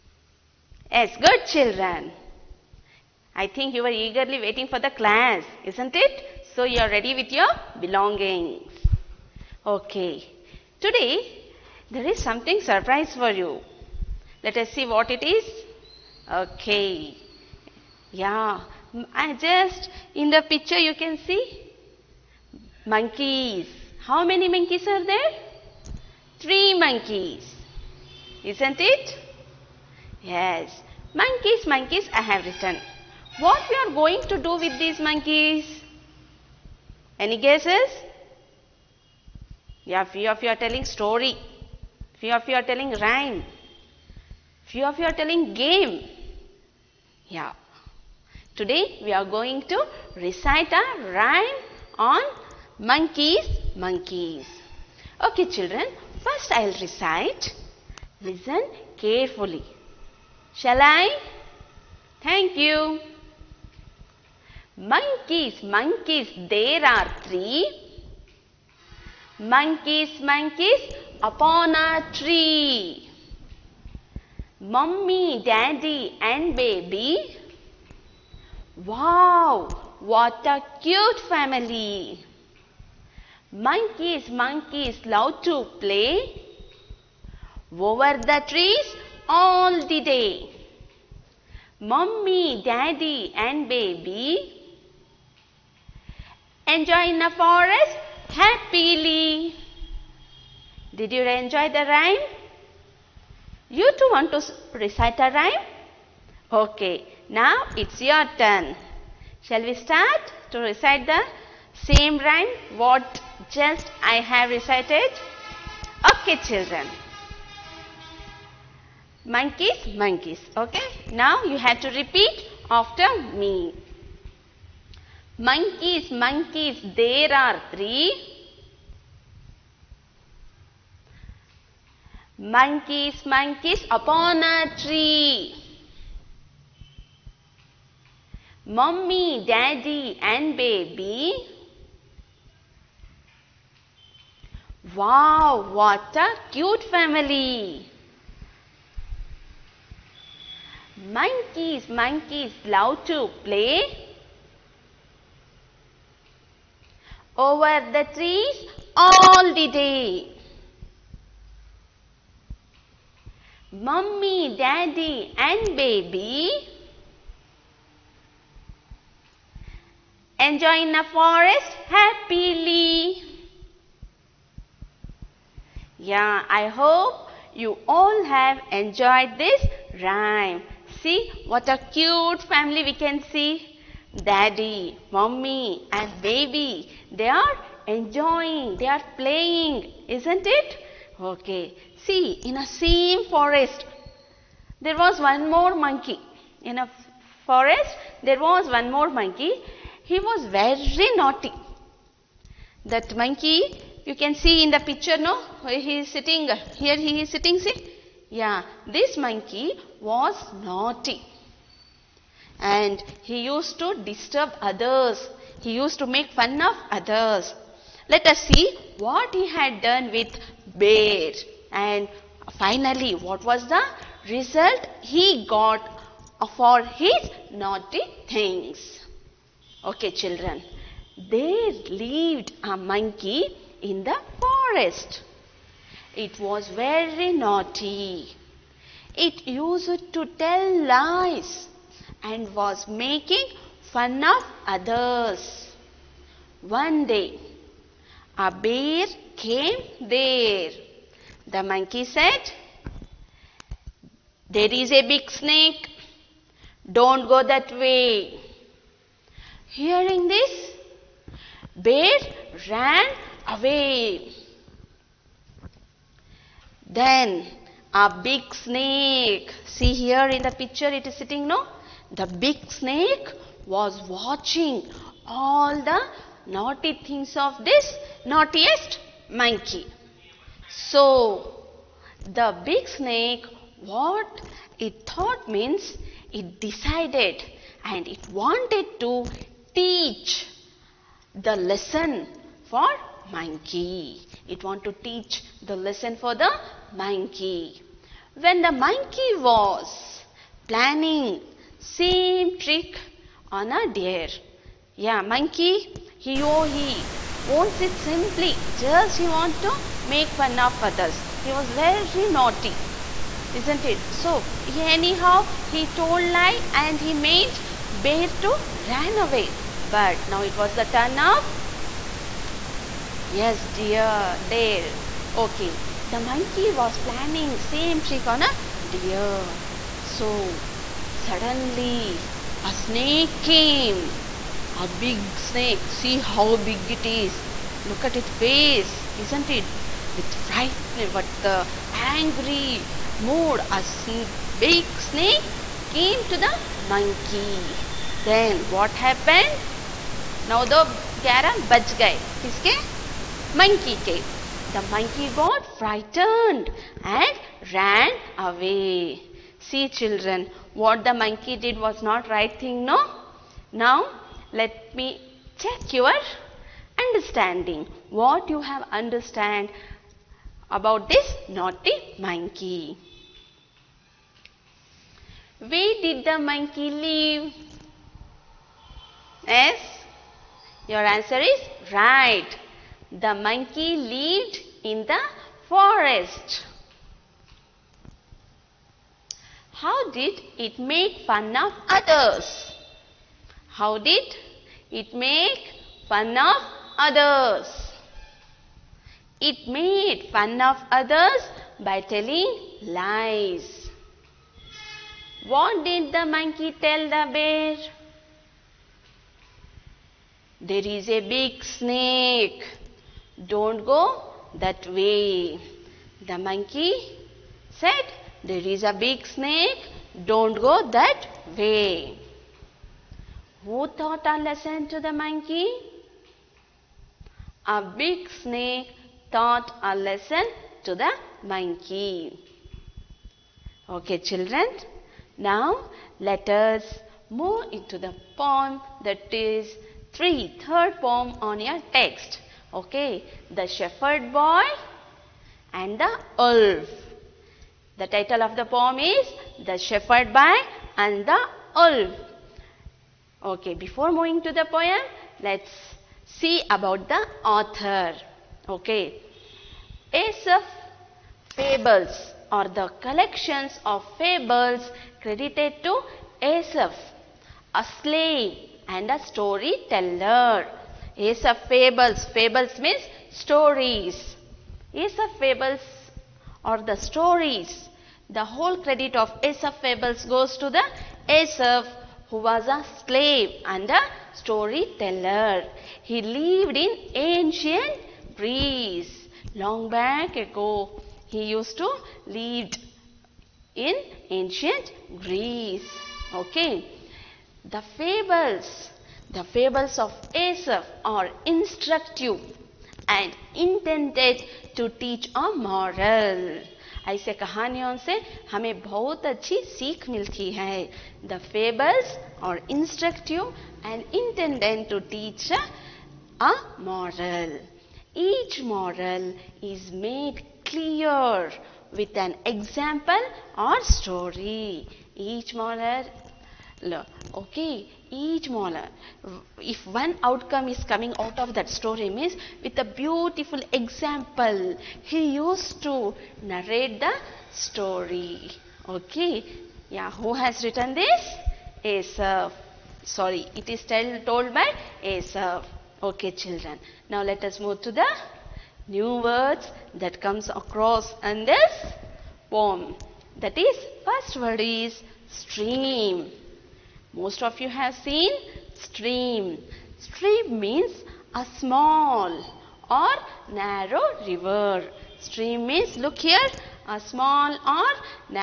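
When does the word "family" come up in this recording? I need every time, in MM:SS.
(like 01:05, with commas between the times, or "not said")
01:21, 02:26, 03:02.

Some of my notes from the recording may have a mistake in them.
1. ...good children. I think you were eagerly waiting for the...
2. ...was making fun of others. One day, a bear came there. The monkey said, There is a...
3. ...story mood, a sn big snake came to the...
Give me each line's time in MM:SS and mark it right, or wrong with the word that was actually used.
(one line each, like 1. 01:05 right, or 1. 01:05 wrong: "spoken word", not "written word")
1. 00:01 right
2. 04:02 right
3. 05:41 wrong: "angry", not "story".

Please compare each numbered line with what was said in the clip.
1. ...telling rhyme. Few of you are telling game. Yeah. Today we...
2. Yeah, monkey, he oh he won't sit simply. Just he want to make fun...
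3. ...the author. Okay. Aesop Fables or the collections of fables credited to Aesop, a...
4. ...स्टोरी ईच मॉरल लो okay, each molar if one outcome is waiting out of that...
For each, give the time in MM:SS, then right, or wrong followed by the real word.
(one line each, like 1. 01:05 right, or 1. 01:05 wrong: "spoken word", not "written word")
1. 00:42 right
2. 05:04 right
3. 07:37 right
4. 08:43 wrong: "coming", not "waiting".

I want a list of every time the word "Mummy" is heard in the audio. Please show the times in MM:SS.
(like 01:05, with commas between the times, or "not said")
01:14, 01:31, 02:43.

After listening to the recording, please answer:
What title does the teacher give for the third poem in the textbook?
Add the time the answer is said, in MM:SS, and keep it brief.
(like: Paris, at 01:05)
The Shepherd Boy and the Wolf, at 07:23.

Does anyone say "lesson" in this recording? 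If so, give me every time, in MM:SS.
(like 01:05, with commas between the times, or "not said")
04:51, 04:55, 07:04, 07:09.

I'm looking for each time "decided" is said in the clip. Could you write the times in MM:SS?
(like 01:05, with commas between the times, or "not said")
04:46.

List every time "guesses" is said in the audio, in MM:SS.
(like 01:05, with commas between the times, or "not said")
00:37.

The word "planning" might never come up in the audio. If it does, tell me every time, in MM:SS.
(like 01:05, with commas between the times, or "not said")
05:00, 05:26.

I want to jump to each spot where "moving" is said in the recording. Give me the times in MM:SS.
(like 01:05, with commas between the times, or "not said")
07:34.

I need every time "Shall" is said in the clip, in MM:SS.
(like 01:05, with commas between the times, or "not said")
01:00, 01:49.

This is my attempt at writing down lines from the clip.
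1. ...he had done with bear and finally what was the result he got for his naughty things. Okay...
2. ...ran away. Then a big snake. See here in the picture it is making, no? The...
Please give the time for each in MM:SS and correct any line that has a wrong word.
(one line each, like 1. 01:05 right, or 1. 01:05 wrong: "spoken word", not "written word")
1. 03:39 right
2. 04:22 wrong: "sitting", not "making".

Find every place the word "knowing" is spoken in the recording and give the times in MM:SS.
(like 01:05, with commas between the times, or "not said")
not said.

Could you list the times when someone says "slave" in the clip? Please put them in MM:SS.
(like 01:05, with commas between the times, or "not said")
07:48, 08:03.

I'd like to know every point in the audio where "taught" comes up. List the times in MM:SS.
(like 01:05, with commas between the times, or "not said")
07:03, 07:09.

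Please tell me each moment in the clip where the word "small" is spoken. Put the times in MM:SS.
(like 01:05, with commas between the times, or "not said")
09:21, 09:26.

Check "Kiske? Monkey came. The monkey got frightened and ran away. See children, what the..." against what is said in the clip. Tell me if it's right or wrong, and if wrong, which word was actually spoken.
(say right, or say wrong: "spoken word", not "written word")
right.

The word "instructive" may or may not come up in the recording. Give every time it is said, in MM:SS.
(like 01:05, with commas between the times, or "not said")
08:21.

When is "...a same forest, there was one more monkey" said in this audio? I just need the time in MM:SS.
03:12.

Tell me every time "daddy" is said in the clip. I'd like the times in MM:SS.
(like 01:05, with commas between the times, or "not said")
01:15, 01:32, 02:19, 02:44, 03:04.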